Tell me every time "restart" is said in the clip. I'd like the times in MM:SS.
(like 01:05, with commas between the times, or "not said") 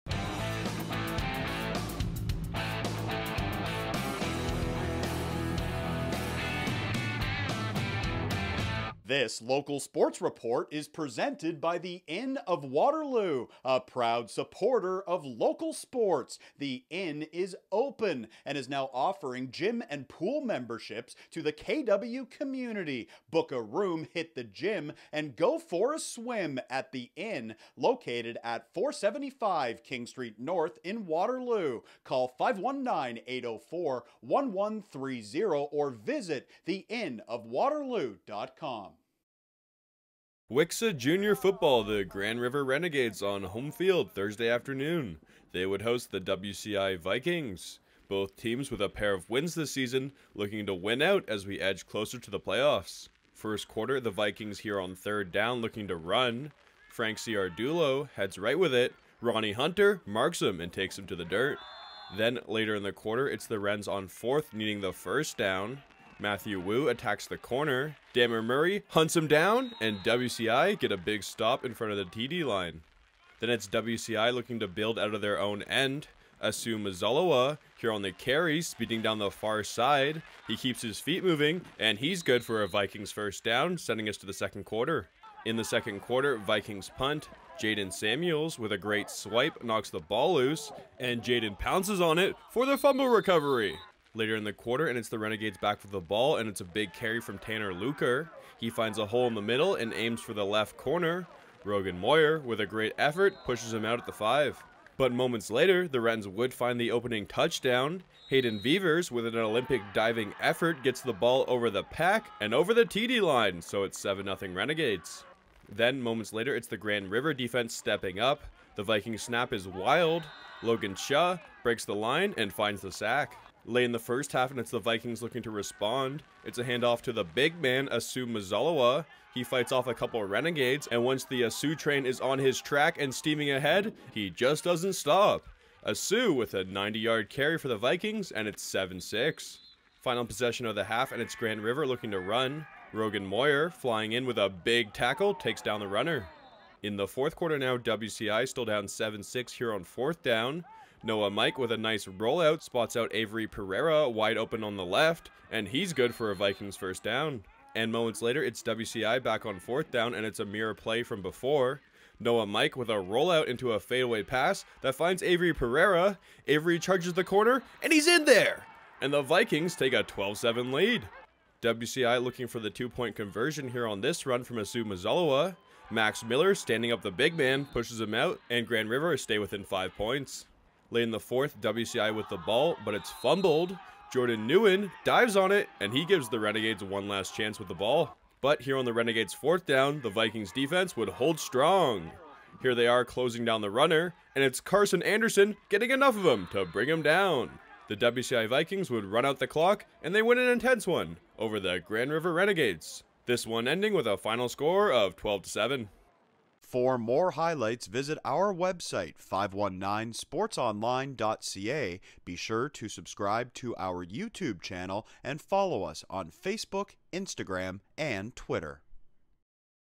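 not said.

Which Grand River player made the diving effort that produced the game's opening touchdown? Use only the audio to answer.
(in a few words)
Hayden Beavers.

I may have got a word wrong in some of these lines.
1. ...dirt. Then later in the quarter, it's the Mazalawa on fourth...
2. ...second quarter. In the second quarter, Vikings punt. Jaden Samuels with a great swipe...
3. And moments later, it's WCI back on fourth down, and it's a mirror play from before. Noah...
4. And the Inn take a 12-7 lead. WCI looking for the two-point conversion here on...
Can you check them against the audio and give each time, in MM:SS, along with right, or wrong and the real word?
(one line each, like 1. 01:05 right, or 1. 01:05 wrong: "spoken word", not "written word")
1. 01:01 wrong: "Rens", not "Mazalawa"
2. 01:24 right
3. 02:37 right
4. 02:49 wrong: "Vikings", not "Inn".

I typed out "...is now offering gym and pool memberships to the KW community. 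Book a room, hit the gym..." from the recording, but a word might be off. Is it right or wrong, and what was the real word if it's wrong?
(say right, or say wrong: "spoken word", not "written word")
right.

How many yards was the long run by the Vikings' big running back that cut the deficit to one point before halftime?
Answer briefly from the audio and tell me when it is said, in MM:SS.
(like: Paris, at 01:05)
90, at 02:16.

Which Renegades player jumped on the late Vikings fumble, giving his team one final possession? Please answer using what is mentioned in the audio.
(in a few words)
Jordan Nguyen.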